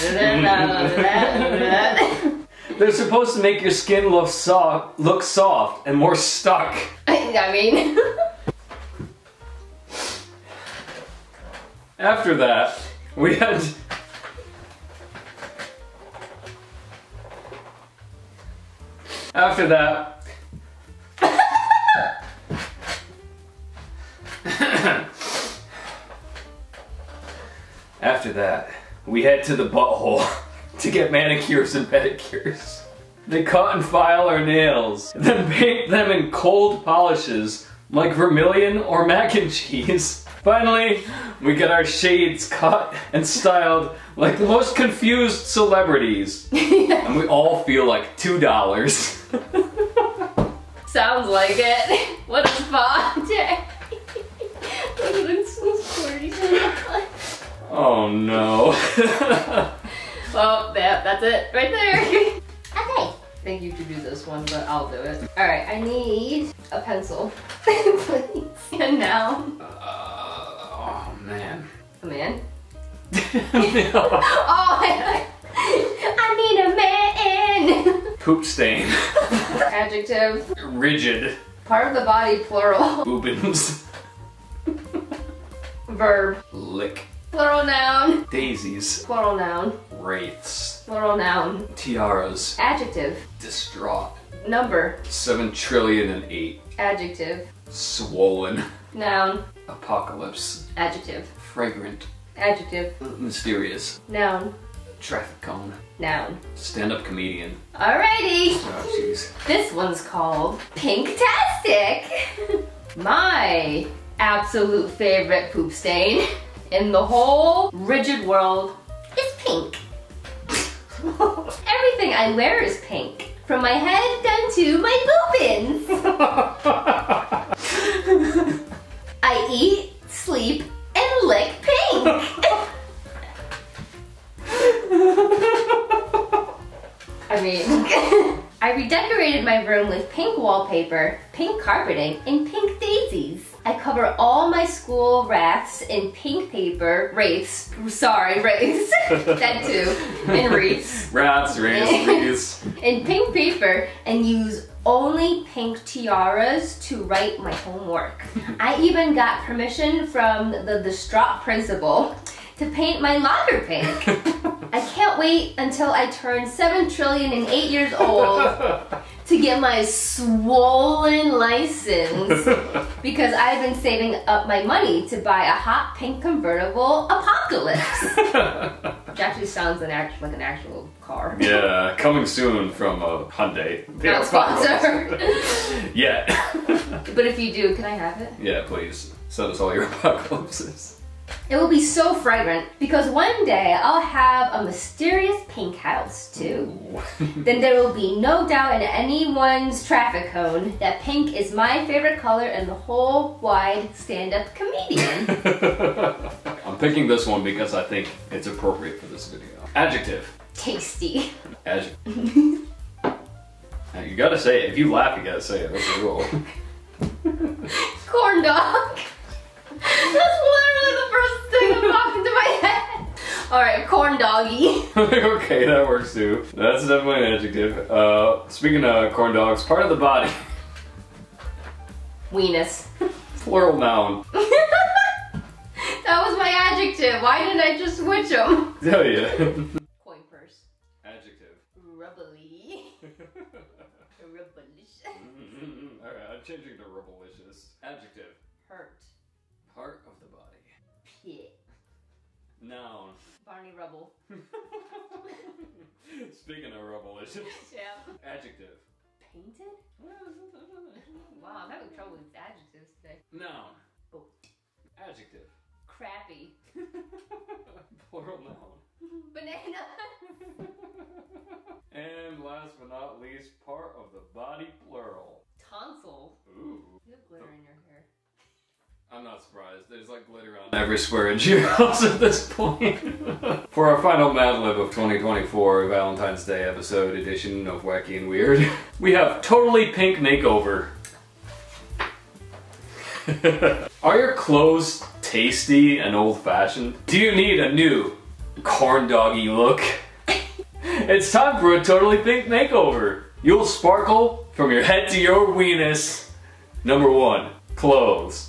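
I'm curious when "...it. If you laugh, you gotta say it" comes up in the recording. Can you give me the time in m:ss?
3:34.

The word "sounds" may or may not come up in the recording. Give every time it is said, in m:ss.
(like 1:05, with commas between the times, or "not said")
0:50, 2:59.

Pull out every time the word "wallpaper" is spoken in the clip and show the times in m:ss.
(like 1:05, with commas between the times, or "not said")
2:20.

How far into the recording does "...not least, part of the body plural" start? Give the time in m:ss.
4:32.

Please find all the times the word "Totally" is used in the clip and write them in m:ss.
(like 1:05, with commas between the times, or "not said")
4:49, 5:01.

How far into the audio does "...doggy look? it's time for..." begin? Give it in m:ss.
4:59.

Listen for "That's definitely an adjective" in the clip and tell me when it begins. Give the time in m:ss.
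3:46.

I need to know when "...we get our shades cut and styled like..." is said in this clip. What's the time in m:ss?
0:41.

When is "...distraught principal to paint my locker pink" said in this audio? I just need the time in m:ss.
2:40.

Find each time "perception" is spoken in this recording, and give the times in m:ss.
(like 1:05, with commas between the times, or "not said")
not said.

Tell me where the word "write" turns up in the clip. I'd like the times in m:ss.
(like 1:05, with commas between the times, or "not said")
2:37.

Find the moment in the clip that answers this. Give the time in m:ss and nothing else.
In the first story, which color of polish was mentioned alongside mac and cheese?
0:38.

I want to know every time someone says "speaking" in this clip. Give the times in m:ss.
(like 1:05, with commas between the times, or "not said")
3:48, 4:16.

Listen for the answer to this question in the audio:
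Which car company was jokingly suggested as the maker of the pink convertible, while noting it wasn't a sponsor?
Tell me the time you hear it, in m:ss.
3:03.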